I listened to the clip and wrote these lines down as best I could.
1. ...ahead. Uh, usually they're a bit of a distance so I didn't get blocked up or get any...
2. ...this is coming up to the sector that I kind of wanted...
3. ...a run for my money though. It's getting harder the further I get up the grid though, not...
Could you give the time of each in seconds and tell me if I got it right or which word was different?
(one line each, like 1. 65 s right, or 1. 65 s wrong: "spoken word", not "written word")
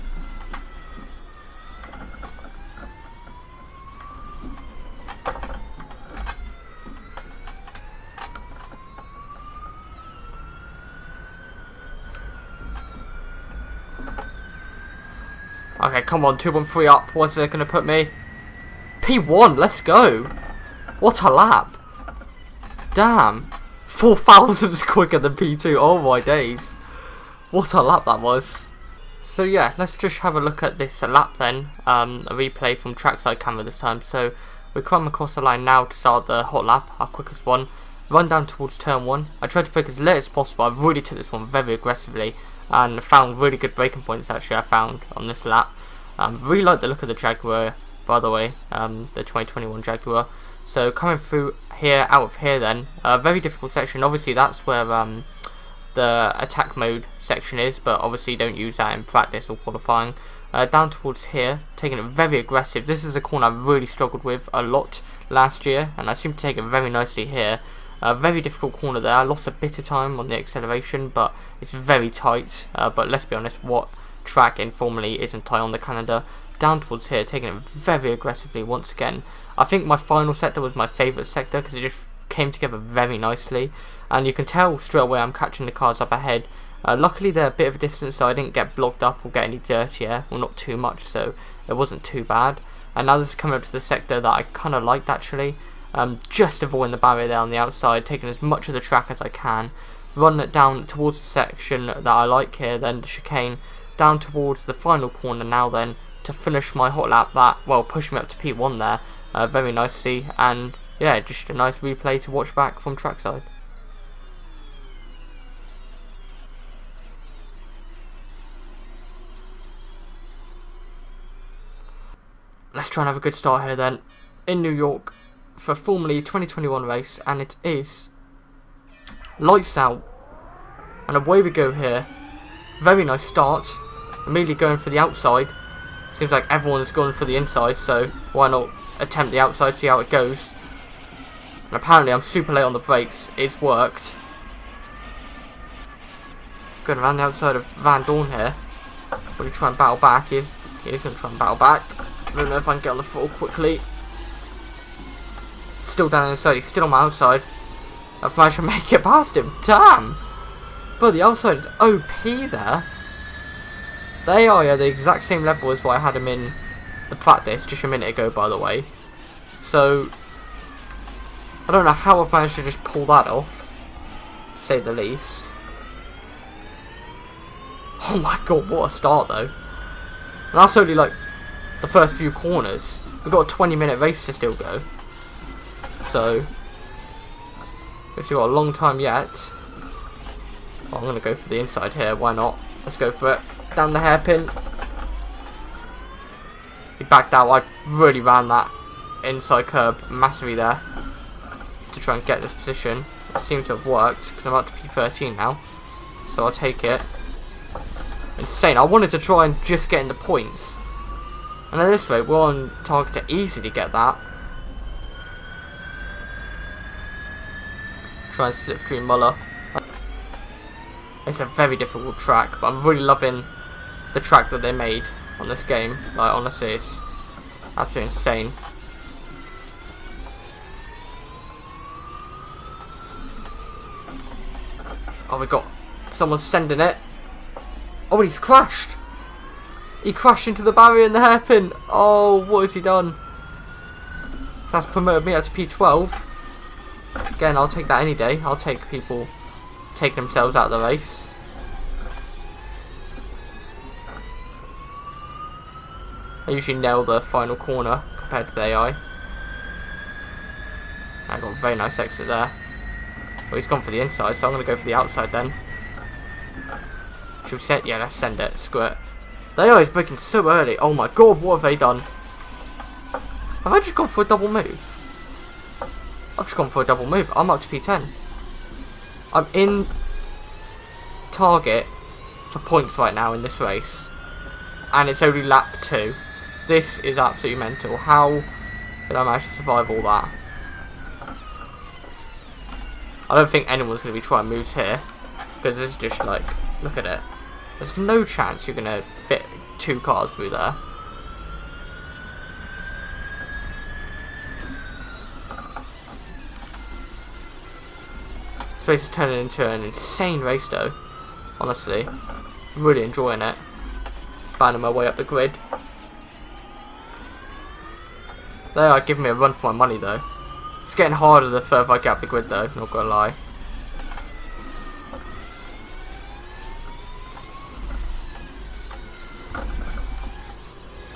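1. 86 s wrong: "luckily", not "usually"
2. 93 s wrong: "liked", not "wanted"
3. 319 s right.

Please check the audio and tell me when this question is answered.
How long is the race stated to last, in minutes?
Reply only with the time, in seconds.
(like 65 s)
183 s.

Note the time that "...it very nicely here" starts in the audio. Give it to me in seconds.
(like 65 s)
66 s.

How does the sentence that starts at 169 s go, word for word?
So, I don't know how I've managed to just pull that off, say the least.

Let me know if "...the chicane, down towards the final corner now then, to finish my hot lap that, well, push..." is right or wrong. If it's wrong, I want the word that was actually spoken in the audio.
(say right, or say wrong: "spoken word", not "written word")
right.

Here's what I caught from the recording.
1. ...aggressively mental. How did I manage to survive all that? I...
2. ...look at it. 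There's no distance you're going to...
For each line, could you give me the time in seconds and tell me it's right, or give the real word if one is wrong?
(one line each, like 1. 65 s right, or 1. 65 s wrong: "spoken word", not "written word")
1. 287 s wrong: "absolutely", not "aggressively"
2. 296 s wrong: "chance", not "distance".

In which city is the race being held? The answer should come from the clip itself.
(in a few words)
New York.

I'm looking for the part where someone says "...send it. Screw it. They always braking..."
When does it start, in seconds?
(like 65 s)
268 s.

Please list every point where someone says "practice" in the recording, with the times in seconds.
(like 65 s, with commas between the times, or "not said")
59 s, 167 s.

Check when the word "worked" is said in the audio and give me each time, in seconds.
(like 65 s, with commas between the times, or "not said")
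143 s, 203 s.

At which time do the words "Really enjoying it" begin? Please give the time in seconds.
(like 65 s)
312 s.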